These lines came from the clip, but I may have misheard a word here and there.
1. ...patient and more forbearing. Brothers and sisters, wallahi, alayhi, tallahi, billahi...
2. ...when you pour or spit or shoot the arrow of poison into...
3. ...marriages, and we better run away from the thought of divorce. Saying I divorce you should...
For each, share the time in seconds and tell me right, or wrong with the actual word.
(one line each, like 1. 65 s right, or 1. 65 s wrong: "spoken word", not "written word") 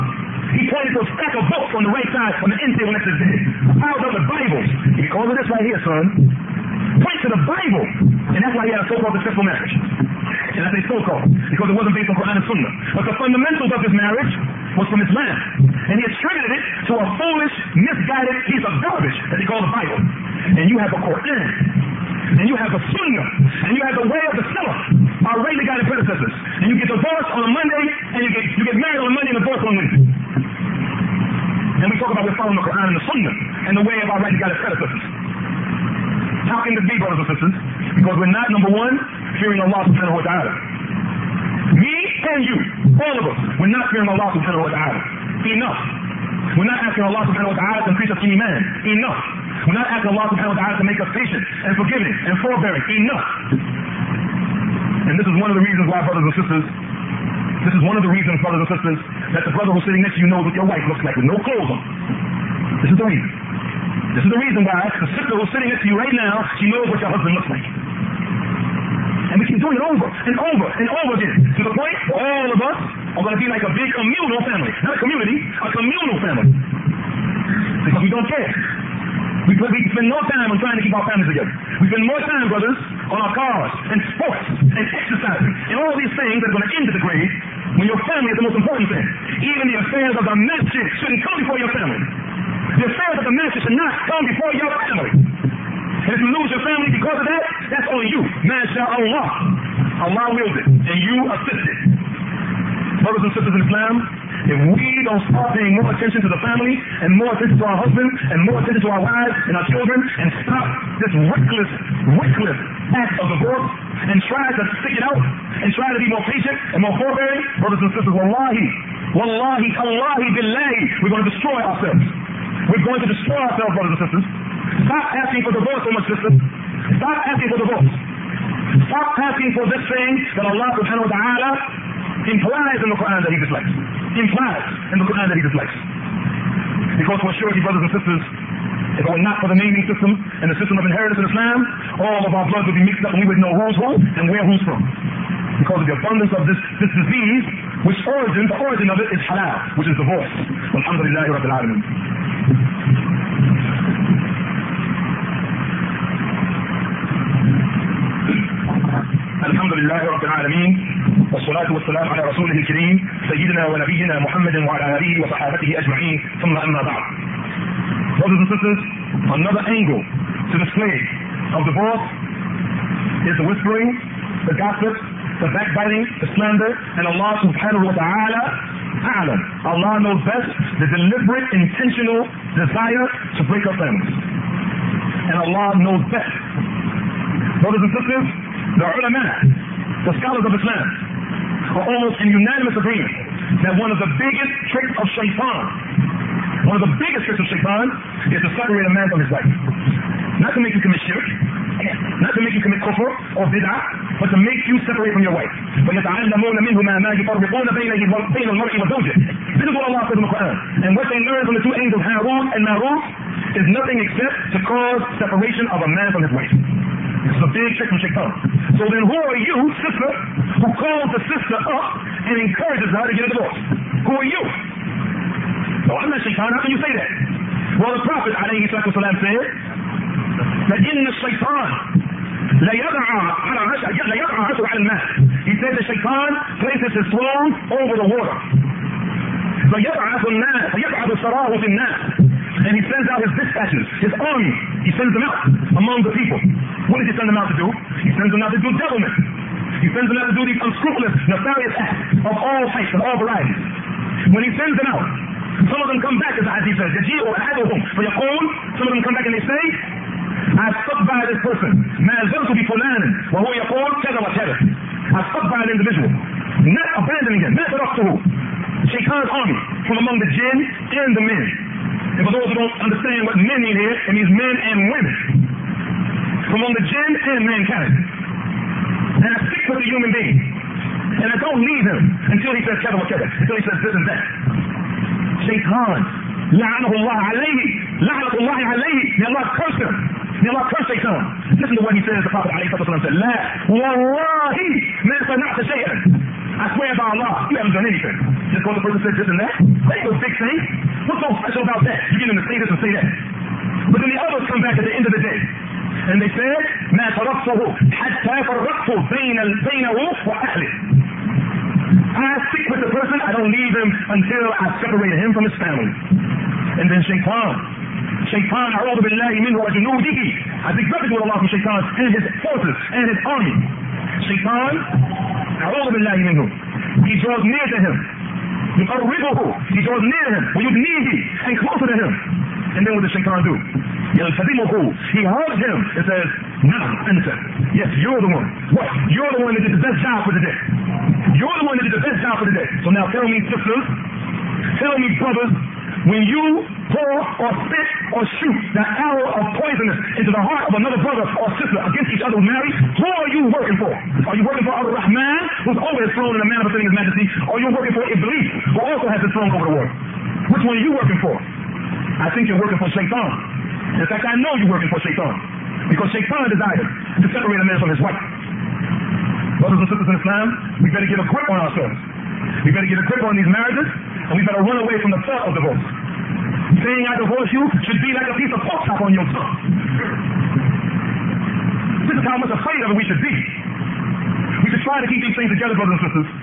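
1. 116 s wrong: "wallahi", not "alayhi"
2. 346 s right
3. 373 s right.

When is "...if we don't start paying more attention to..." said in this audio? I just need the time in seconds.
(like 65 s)
104 s.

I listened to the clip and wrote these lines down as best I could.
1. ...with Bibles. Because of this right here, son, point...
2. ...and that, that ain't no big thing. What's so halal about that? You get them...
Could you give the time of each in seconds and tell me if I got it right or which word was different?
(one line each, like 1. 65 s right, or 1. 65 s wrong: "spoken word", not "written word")
1. 4 s right
2. 299 s wrong: "special", not "halal".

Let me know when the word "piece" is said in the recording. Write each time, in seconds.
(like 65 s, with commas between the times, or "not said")
18 s, 378 s.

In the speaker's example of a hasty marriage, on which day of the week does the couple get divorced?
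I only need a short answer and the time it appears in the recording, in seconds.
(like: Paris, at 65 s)
Wednesday, at 29 s.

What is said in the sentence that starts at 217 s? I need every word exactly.
This is a big trick from Shaitan.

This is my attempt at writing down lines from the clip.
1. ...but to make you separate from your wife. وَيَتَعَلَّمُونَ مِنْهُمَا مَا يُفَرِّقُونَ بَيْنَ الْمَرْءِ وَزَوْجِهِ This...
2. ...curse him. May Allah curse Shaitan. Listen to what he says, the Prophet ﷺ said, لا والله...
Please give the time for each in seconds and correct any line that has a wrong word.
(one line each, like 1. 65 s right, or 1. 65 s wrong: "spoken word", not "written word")
1. 204 s right
2. 289 s right.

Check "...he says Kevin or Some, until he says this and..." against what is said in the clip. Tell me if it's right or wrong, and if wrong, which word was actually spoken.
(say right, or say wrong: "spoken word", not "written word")
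wrong: "Kevin", not "Some".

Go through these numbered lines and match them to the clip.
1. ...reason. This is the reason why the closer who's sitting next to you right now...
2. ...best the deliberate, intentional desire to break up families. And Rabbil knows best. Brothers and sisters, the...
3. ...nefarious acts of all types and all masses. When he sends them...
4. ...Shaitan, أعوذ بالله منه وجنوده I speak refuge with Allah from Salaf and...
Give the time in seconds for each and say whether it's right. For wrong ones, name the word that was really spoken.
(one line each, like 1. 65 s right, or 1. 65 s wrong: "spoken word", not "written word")
1. 63 s wrong: "sister", not "closer"
2. 180 s wrong: "Allah", not "Rabbil"
3. 251 s wrong: "varieties", not "masses"
4. 318 s wrong: "Shaitan", not "Salaf".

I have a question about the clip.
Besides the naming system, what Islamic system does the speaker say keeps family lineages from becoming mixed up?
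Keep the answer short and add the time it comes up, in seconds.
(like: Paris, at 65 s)
Inheritance, at 140 s.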